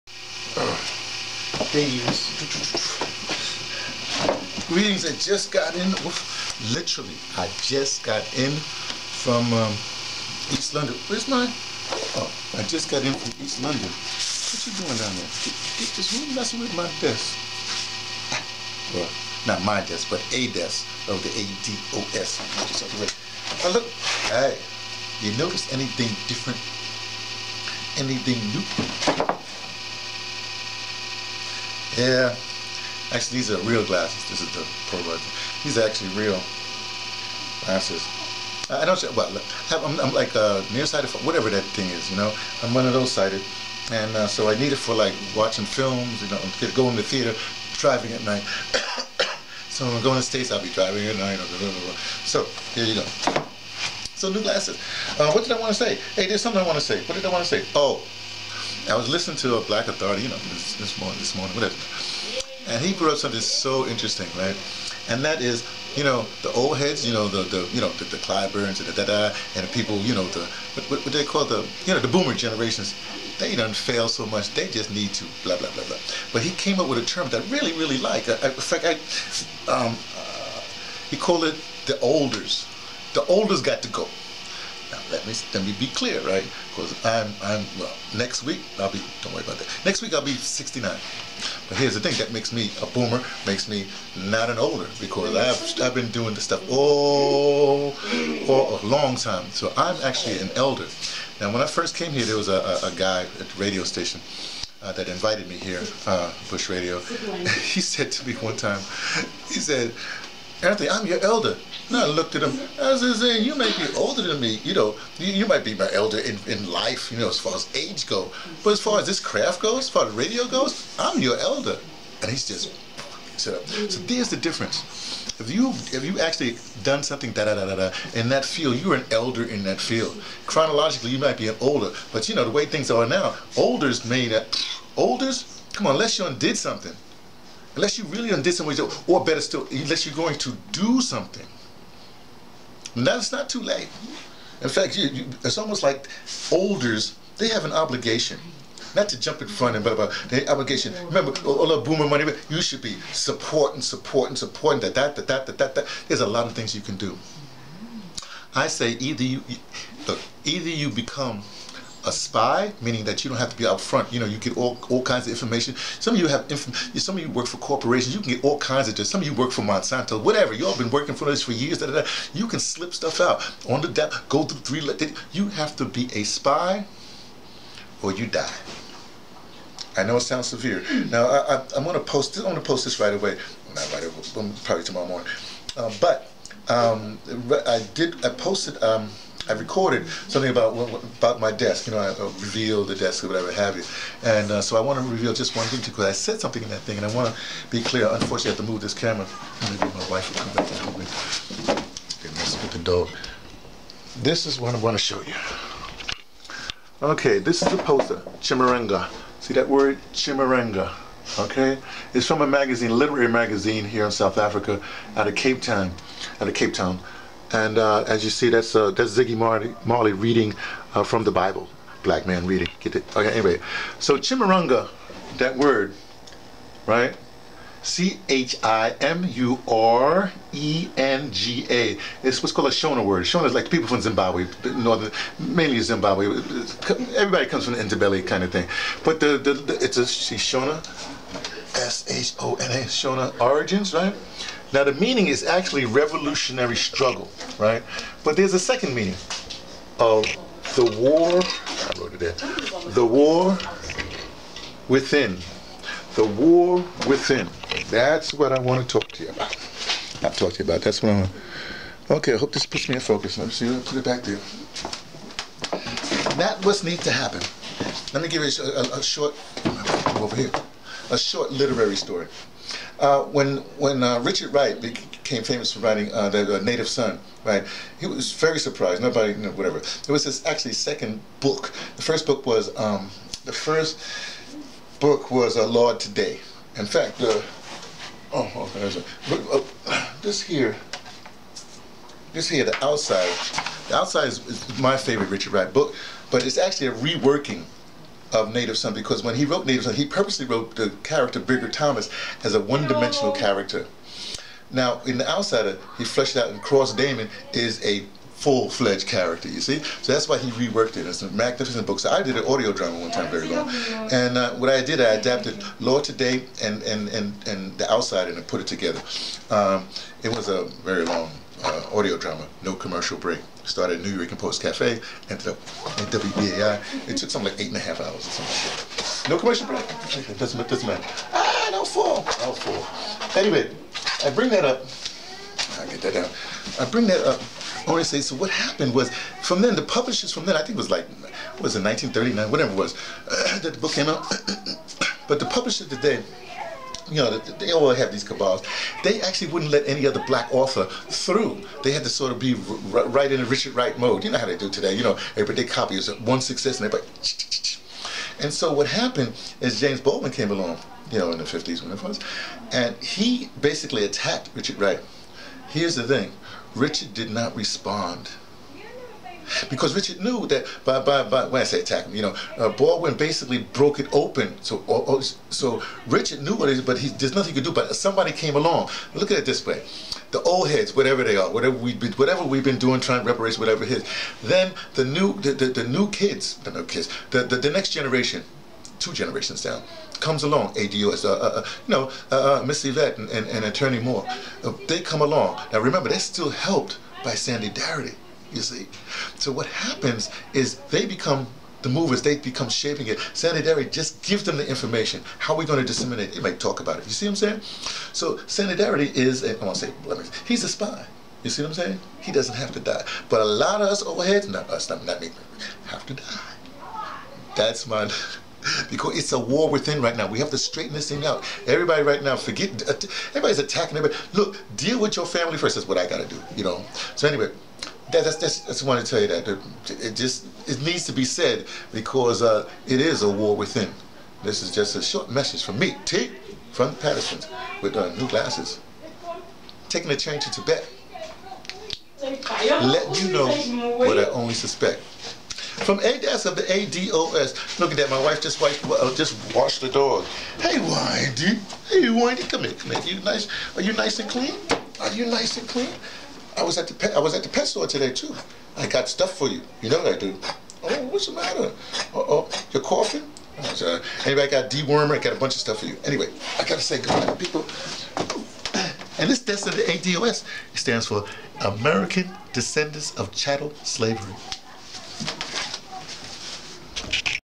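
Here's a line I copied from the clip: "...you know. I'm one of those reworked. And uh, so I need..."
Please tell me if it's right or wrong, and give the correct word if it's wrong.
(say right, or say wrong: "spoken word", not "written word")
wrong: "sighted", not "reworked".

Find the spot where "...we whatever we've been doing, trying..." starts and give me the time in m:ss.
6:21.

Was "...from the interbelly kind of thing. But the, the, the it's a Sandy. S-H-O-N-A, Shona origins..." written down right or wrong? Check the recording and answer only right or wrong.
wrong.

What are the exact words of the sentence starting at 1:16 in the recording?
But he came up with a term that I really, really like.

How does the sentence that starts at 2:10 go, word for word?
Chronologically, you might be an older, but you know the way things are now, olders made not.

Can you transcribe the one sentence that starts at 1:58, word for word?
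But as far as this craft goes, as far as radio goes, I'm your elder.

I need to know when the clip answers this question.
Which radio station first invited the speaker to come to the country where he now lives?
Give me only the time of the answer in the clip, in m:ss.
1:46.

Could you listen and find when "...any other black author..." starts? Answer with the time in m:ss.
5:49.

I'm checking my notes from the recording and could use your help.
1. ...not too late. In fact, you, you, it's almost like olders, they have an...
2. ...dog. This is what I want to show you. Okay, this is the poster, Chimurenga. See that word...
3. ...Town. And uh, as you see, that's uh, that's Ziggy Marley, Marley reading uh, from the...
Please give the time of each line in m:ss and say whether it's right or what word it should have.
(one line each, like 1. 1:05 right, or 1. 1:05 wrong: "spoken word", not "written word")
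1. 2:23 right
2. 3:22 right
3. 3:36 right.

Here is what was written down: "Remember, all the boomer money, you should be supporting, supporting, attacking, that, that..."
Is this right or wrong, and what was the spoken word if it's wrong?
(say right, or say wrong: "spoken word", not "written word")
wrong: "supporting", not "attacking".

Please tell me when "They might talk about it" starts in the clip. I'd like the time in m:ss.
6:46.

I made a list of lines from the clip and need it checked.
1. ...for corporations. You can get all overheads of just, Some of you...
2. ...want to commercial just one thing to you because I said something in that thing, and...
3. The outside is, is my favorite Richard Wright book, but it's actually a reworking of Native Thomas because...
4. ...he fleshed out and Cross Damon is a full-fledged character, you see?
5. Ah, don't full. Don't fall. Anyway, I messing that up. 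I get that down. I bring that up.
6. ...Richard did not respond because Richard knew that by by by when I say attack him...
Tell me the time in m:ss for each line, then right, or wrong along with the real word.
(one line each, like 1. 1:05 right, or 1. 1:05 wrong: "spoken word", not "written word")
1. 2:47 wrong: "kinds", not "overheads"
2. 3:14 wrong: "reveal", not "commercial"
3. 4:53 wrong: "Son", not "Thomas"
4. 5:05 right
5. 5:31 wrong: "bring", not "messing"
6. 6:06 right.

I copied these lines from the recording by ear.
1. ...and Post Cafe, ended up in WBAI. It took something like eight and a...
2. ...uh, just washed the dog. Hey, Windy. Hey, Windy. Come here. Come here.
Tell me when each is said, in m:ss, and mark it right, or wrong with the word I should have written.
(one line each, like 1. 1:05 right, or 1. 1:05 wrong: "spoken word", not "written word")
1. 5:24 right
2. 7:28 right.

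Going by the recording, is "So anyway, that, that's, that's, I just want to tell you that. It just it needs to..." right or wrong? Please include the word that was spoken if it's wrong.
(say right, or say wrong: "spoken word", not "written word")
right.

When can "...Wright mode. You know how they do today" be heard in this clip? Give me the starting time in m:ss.
5:53.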